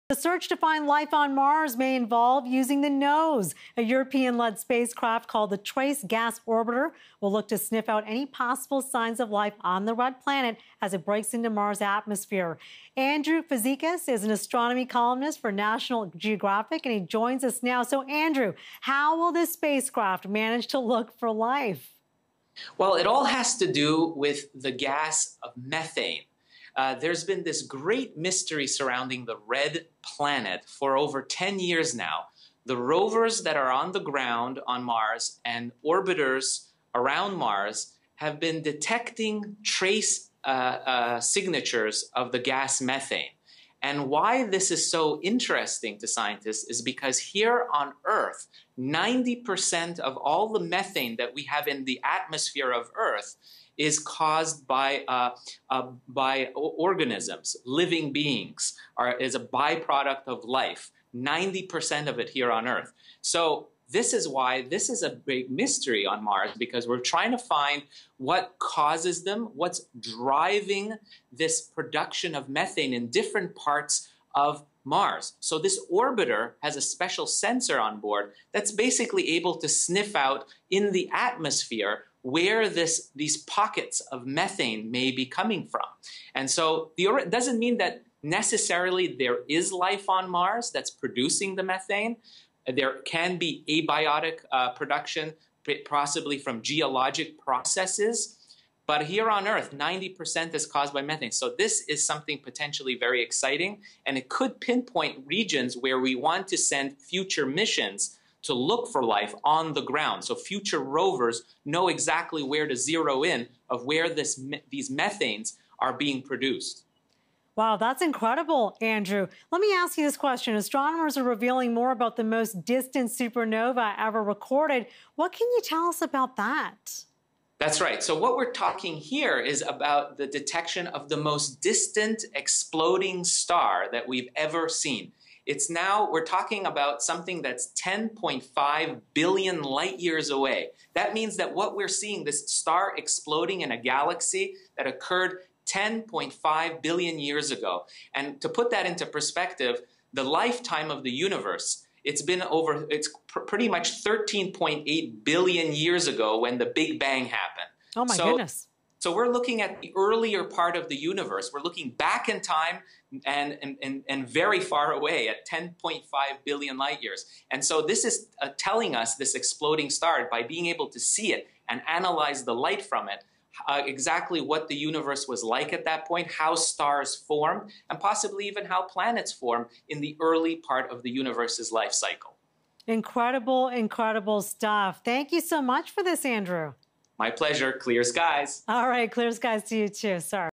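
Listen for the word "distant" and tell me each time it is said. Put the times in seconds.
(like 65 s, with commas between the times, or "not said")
122 s, 131 s.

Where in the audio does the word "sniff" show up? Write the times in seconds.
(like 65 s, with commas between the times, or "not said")
7 s, 79 s.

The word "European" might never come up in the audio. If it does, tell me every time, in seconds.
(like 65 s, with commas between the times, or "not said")
3 s.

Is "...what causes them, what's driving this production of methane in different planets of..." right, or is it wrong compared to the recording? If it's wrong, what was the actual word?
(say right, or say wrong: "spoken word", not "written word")
wrong: "parts", not "planets".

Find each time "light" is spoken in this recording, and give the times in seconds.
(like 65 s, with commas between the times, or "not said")
139 s, 166 s, 172 s.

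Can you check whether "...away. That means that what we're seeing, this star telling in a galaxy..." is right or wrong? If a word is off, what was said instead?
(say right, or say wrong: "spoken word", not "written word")
wrong: "exploding", not "telling".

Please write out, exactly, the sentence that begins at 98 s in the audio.
But here on Earth, 90% is caused by methane.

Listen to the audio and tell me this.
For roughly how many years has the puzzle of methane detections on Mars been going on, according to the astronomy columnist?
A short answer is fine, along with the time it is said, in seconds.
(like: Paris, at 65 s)
over 10 years, at 30 s.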